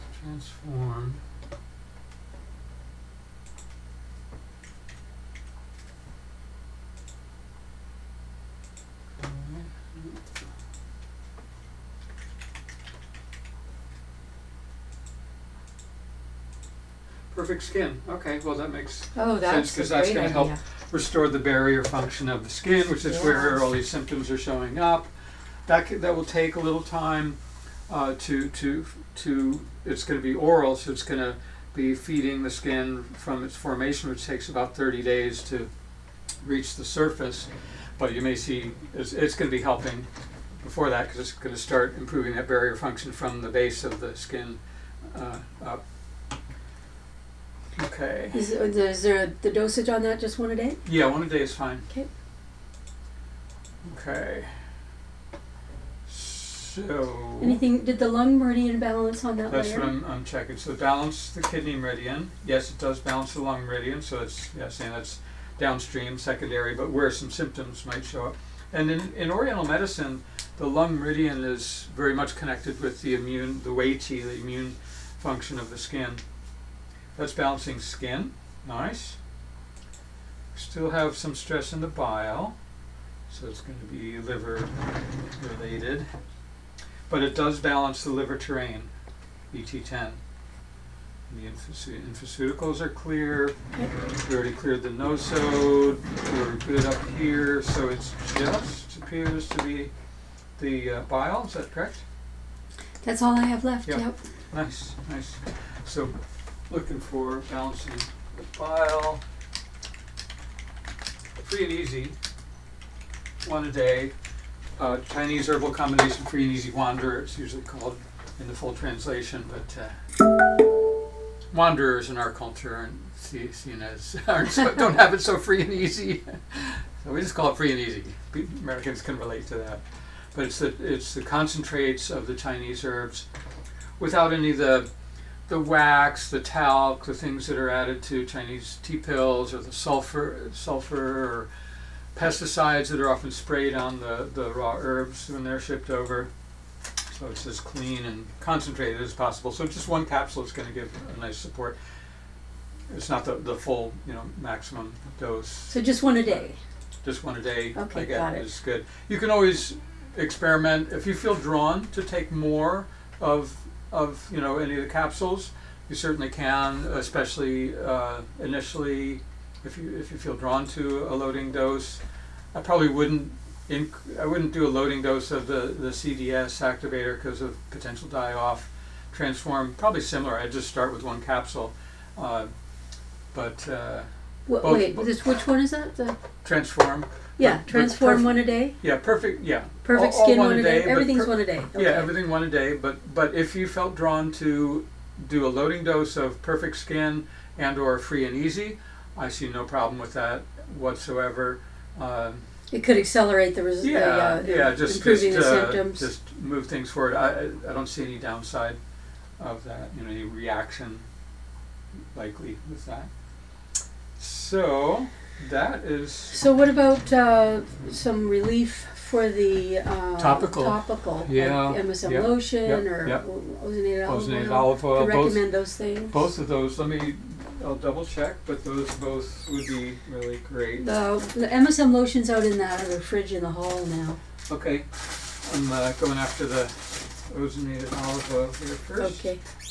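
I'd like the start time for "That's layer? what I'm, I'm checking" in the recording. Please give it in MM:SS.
00:59.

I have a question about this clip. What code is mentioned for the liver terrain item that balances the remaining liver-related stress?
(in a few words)
ET10.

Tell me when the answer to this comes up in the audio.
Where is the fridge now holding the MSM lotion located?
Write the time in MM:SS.
03:53.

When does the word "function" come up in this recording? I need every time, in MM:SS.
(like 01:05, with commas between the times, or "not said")
00:21, 00:42, 01:15.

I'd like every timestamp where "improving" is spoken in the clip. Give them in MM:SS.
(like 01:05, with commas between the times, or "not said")
00:41, 03:24.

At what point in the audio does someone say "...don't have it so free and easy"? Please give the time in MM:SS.
02:04.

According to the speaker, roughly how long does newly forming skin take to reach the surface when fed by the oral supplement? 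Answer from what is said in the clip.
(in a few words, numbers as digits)
30 days.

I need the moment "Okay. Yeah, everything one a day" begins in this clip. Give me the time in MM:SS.
03:11.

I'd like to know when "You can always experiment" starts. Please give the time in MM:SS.
02:39.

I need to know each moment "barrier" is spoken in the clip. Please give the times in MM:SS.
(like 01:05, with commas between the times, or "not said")
00:21, 00:42.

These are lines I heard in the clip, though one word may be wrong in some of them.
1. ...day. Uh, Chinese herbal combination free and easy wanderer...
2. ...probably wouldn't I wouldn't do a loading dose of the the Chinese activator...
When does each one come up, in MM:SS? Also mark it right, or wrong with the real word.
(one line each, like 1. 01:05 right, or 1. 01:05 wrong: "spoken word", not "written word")
1. 01:53 right
2. 02:52 wrong: "CDS", not "Chinese".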